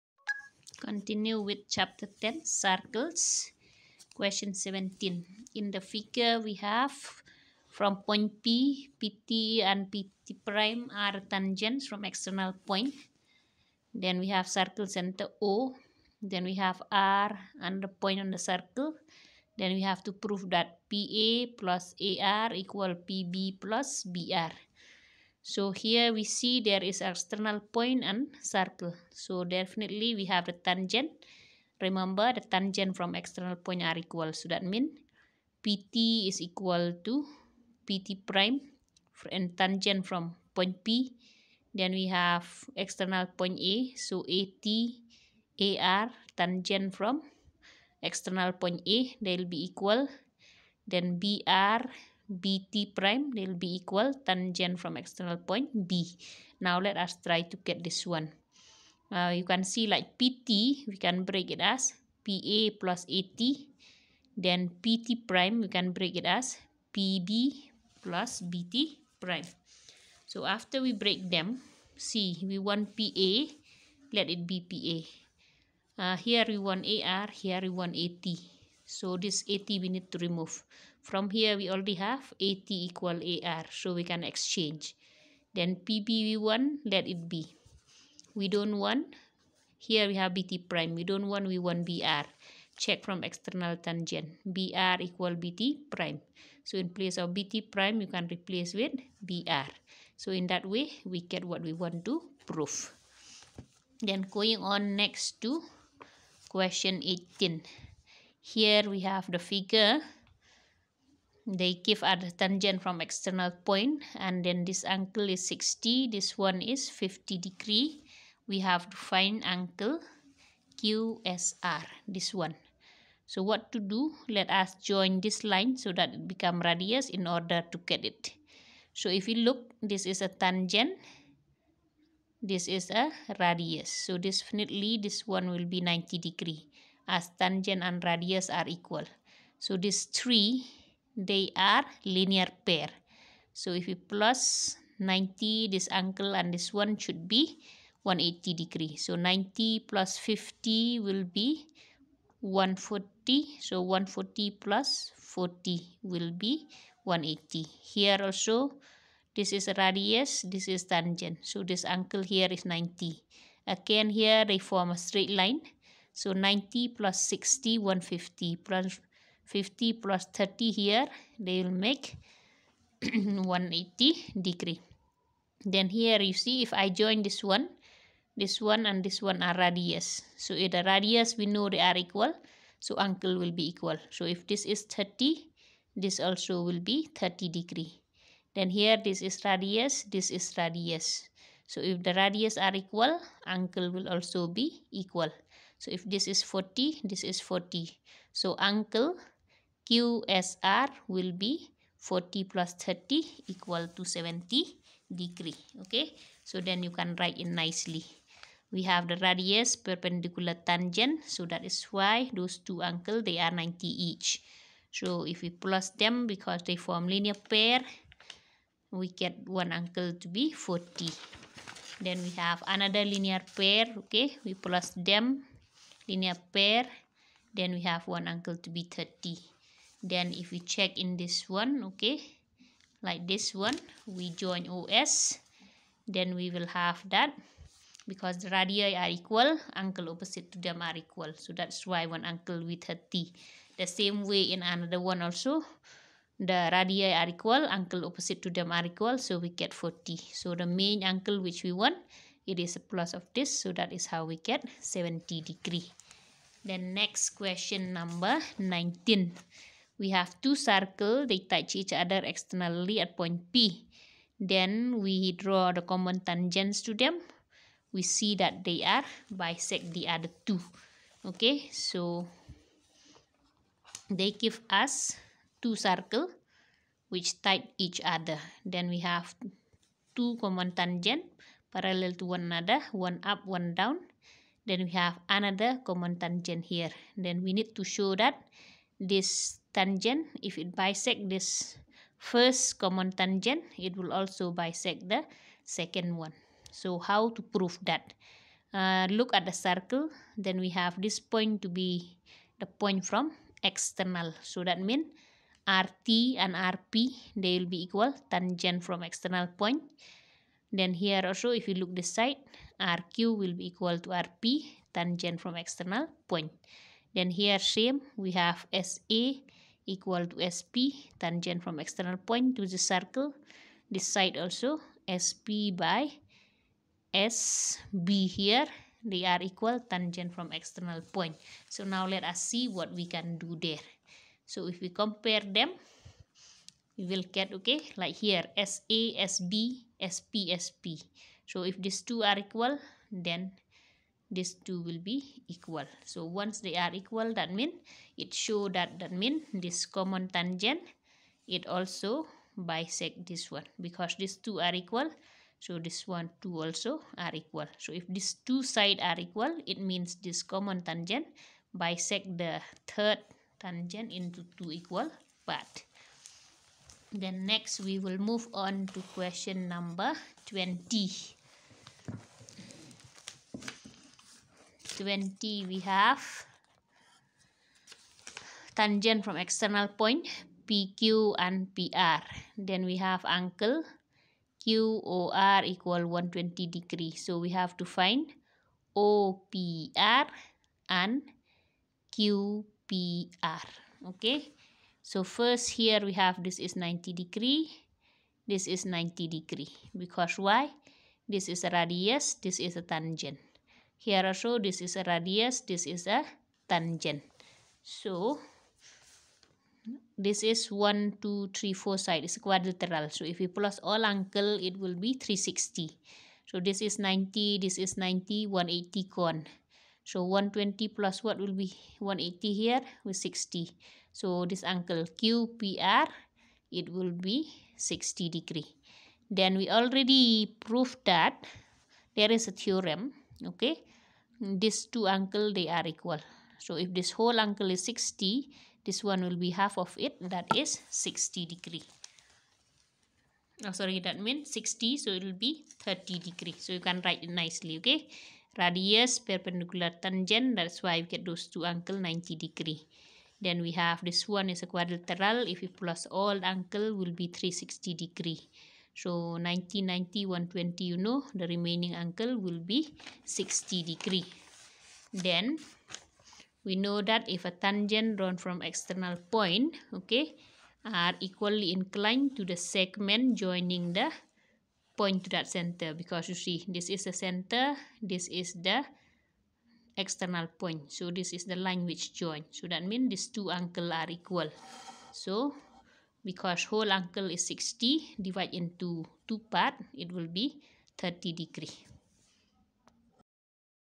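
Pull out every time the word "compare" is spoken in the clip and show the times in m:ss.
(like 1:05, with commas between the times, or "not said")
5:34.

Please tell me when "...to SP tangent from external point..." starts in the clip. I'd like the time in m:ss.
5:20.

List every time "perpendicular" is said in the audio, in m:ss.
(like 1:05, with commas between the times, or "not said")
3:29, 7:29.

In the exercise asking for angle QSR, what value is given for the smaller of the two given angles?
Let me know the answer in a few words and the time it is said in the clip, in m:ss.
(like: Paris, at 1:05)
50 degrees, at 1:56.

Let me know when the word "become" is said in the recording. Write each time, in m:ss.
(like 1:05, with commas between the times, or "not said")
2:06.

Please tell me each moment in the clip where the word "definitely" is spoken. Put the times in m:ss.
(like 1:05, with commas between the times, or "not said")
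0:29, 2:14.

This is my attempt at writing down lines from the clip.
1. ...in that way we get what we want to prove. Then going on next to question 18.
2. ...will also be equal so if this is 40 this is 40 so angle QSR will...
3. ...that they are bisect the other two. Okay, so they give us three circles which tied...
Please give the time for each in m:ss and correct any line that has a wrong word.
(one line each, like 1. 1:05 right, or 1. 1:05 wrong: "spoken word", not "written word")
1. 1:40 right
2. 3:13 right
3. 4:28 wrong: "two", not "three".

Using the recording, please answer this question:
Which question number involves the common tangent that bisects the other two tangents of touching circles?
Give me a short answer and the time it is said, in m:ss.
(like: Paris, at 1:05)
19, at 4:18.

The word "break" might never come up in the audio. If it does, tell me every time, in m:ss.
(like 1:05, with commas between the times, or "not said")
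1:01, 1:05, 1:10.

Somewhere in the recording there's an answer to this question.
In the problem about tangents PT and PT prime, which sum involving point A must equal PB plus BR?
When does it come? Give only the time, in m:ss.
0:20.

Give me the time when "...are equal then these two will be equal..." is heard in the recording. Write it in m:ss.
5:42.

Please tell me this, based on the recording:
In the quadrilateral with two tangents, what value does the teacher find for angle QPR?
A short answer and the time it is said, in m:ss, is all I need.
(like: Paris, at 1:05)
60 degrees, at 7:06.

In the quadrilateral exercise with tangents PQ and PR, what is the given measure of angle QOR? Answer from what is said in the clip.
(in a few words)
120 degrees.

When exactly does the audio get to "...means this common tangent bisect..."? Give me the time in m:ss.
5:59.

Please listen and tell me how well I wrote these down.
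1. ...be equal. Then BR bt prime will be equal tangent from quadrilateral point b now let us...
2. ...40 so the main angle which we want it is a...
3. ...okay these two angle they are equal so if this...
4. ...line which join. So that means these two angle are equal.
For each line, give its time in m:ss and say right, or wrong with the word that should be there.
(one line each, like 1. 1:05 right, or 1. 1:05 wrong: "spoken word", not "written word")
1. 0:49 wrong: "external", not "quadrilateral"
2. 4:09 right
3. 7:13 right
4. 8:01 right.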